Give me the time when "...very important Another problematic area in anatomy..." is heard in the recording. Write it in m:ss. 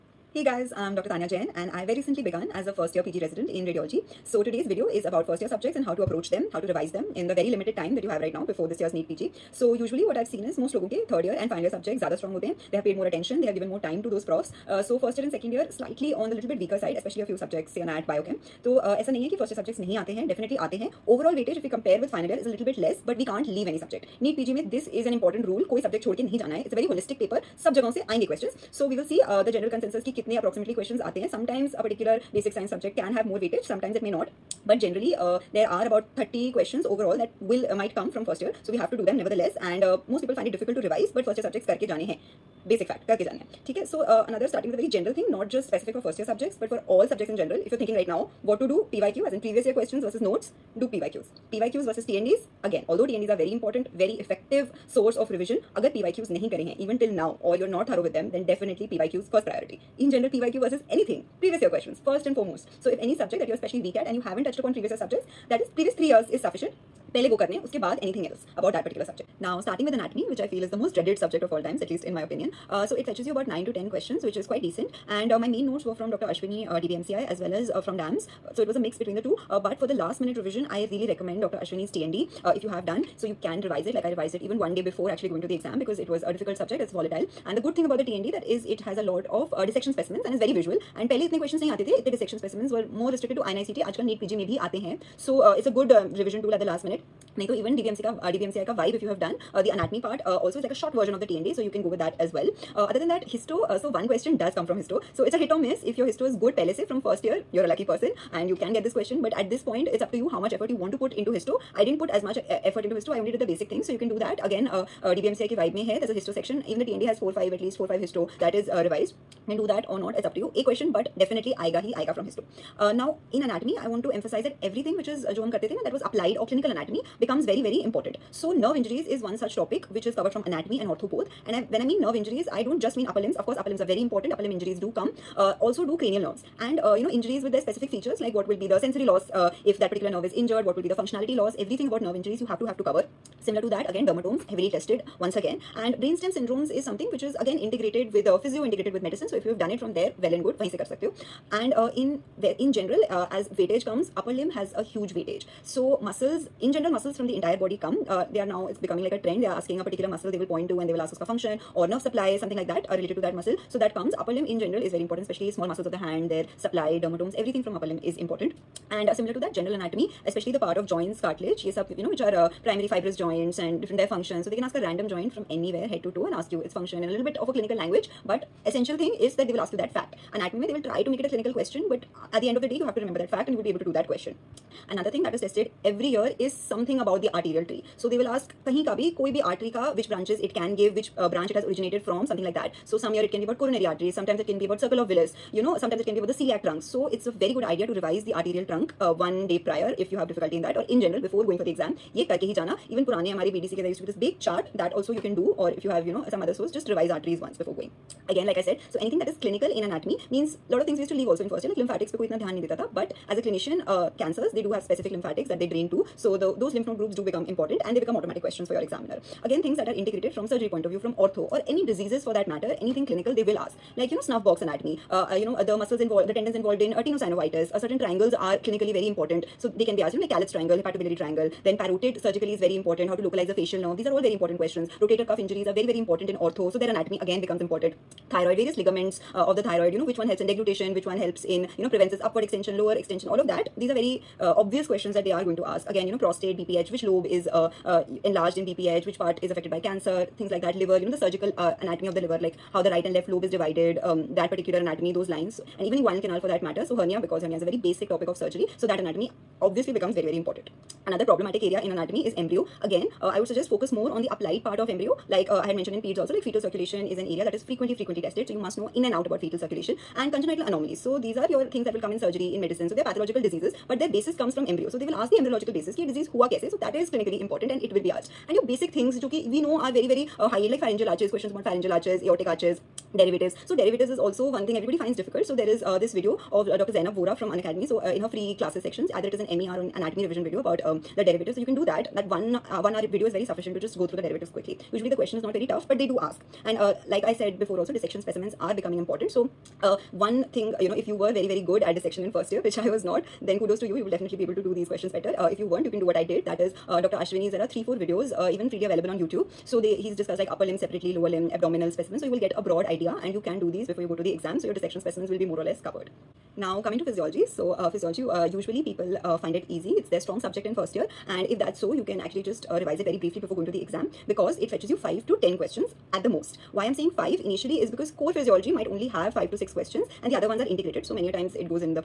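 4:20.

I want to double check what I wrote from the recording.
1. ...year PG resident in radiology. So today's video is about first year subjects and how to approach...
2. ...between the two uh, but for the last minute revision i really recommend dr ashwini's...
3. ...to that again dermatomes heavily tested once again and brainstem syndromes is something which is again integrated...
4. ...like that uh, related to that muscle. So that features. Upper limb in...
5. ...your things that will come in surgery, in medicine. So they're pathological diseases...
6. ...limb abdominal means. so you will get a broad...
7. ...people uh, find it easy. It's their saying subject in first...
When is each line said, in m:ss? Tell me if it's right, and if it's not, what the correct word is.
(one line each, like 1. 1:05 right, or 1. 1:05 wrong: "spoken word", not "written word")
1. 0:02 right
2. 1:18 right
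3. 2:23 right
4. 2:42 wrong: "comes", not "features"
5. 4:31 right
6. 5:11 wrong: "specimens", not "means"
7. 5:18 wrong: "strong", not "saying".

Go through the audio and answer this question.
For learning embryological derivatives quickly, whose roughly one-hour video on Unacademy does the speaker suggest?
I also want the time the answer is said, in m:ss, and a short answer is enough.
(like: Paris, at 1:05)
Dr. Zainab Vora, at 4:46.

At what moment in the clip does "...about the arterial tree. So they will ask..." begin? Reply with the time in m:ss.
3:06.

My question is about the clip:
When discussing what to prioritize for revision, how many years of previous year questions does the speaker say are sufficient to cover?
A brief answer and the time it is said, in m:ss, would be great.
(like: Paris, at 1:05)
3, at 1:05.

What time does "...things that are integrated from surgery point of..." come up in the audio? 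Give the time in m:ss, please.
3:39.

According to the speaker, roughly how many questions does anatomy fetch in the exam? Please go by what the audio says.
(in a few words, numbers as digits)
9 to 10.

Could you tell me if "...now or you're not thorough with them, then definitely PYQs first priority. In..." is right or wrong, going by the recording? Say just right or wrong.
right.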